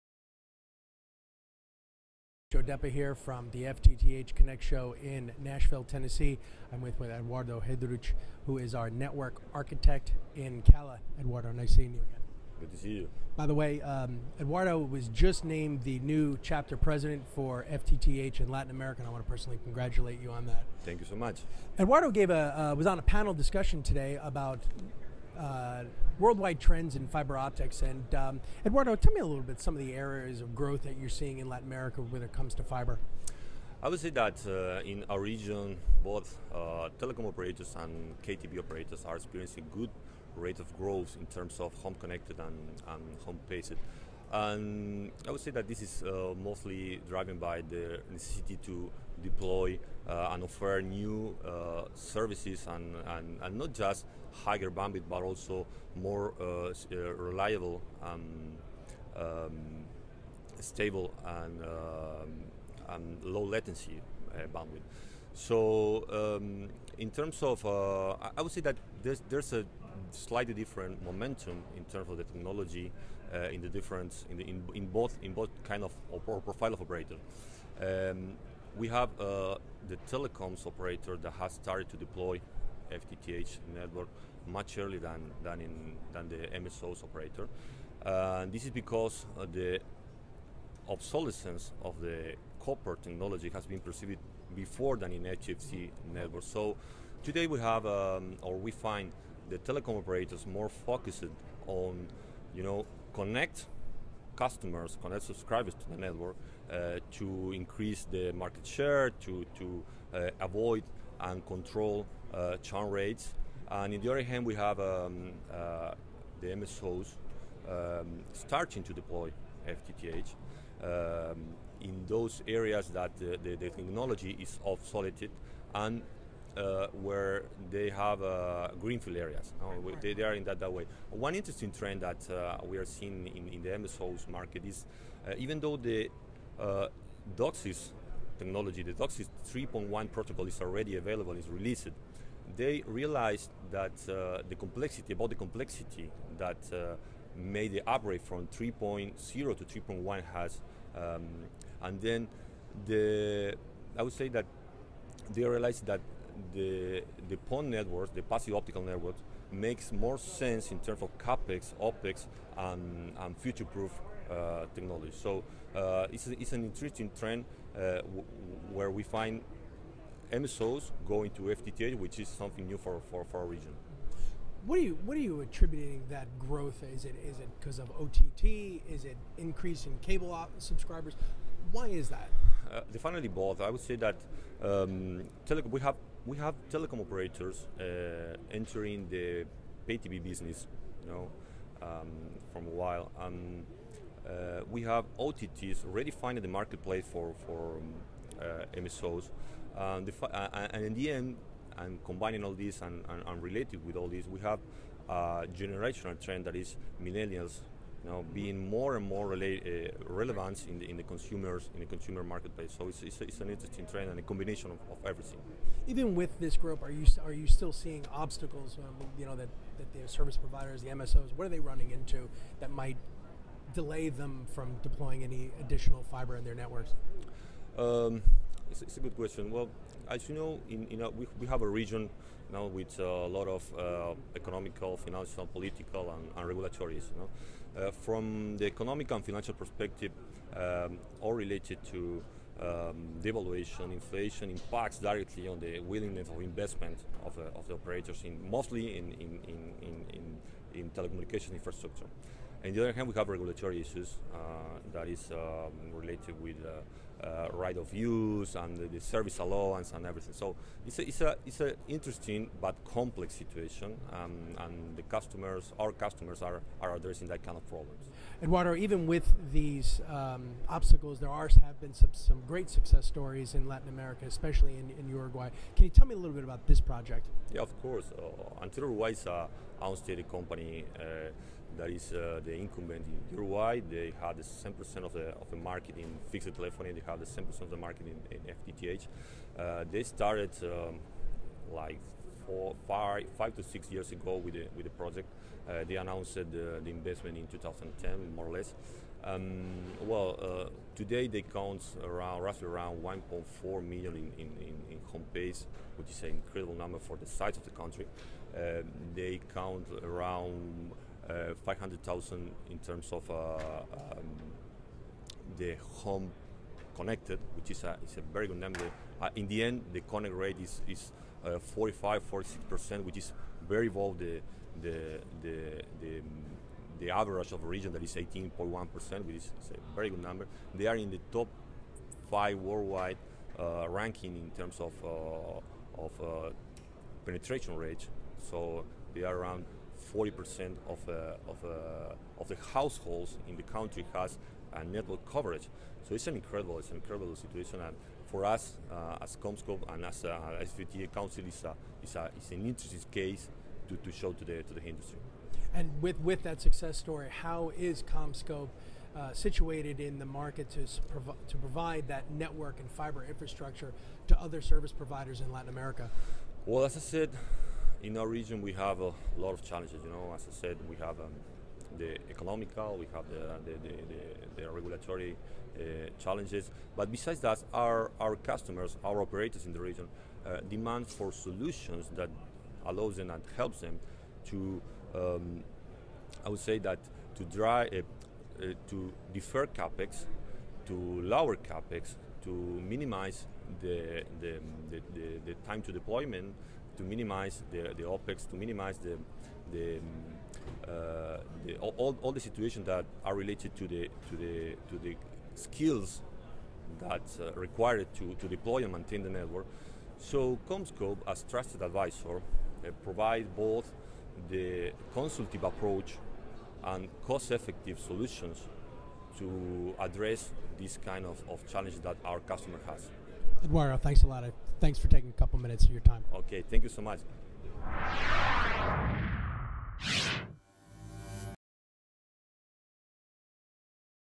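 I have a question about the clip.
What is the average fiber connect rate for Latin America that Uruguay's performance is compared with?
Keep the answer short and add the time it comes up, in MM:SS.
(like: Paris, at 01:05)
18.1%, at 05:28.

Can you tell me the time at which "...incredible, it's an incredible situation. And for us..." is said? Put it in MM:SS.
05:46.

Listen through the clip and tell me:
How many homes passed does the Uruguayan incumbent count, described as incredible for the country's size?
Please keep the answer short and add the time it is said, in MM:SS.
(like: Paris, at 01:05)
1.4 million, at 05:03.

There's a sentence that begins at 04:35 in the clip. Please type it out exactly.
Can you tell me a little bit about this project?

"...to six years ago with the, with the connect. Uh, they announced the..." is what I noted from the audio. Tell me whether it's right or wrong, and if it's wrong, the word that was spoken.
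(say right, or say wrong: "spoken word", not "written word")
wrong: "project", not "connect".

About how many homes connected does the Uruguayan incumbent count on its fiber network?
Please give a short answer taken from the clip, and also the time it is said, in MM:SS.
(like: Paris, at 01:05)
500,000, at 05:11.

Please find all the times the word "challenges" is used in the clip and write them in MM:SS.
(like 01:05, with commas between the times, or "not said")
06:09, 06:16, 07:01.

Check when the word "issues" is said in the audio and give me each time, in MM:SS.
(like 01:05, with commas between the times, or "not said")
03:56, 04:13.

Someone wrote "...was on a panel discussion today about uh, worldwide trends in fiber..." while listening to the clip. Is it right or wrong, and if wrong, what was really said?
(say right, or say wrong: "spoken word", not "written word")
right.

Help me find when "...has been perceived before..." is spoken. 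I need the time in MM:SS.
01:33.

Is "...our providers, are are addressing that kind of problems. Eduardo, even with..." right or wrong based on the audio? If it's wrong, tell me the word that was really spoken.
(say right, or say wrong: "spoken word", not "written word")
wrong: "customers", not "providers".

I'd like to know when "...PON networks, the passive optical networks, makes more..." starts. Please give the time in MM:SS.
02:37.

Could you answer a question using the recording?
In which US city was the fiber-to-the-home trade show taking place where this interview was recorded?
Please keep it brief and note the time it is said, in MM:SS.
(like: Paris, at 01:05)
Nashville, at 00:05.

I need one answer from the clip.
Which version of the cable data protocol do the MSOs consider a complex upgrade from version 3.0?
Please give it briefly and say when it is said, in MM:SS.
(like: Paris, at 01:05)
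DOCSIS 3.1, at 02:18.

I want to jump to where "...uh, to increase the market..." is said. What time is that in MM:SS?
01:46.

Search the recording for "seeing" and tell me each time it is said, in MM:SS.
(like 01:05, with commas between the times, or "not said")
00:11, 00:31, 02:12, 03:37.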